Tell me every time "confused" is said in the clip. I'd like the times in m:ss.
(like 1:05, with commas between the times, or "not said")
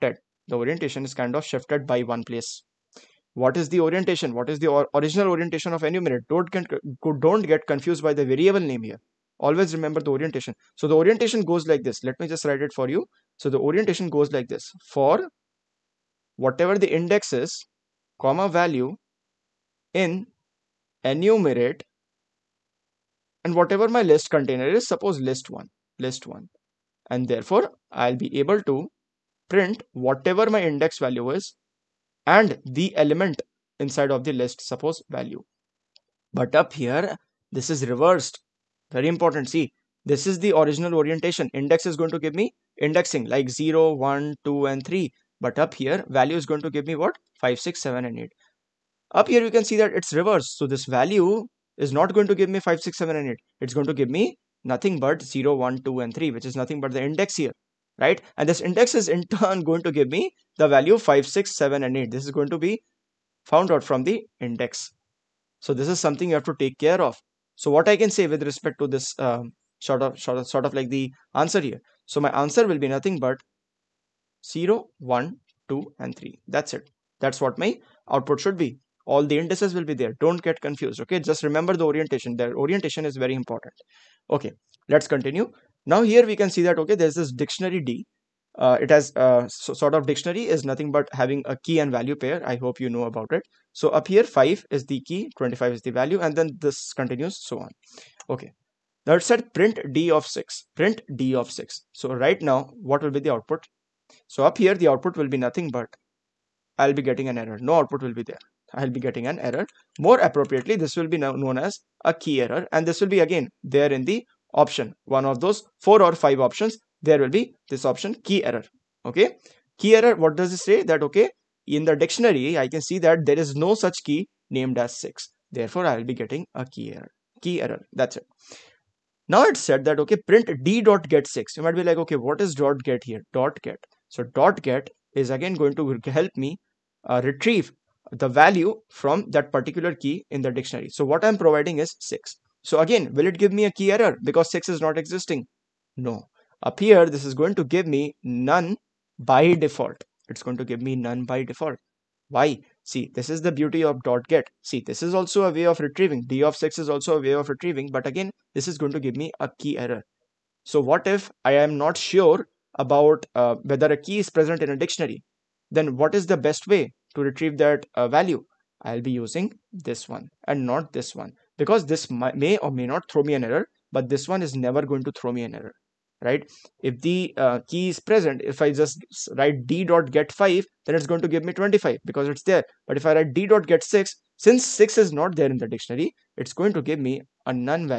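0:07, 1:20.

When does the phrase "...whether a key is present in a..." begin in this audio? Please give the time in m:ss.
2:43.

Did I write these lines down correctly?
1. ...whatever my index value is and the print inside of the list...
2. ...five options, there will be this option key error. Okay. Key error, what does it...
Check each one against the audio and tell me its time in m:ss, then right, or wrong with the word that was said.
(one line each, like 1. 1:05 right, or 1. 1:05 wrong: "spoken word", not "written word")
1. 0:29 wrong: "element", not "print"
2. 1:56 right.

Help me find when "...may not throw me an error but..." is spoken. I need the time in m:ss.
2:52.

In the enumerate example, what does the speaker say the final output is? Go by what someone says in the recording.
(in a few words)
0 1 2 and 3.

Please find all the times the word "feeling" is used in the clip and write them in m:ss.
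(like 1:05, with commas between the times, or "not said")
not said.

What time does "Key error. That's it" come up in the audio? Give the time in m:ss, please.
2:07.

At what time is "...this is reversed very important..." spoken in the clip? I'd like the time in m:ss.
0:37.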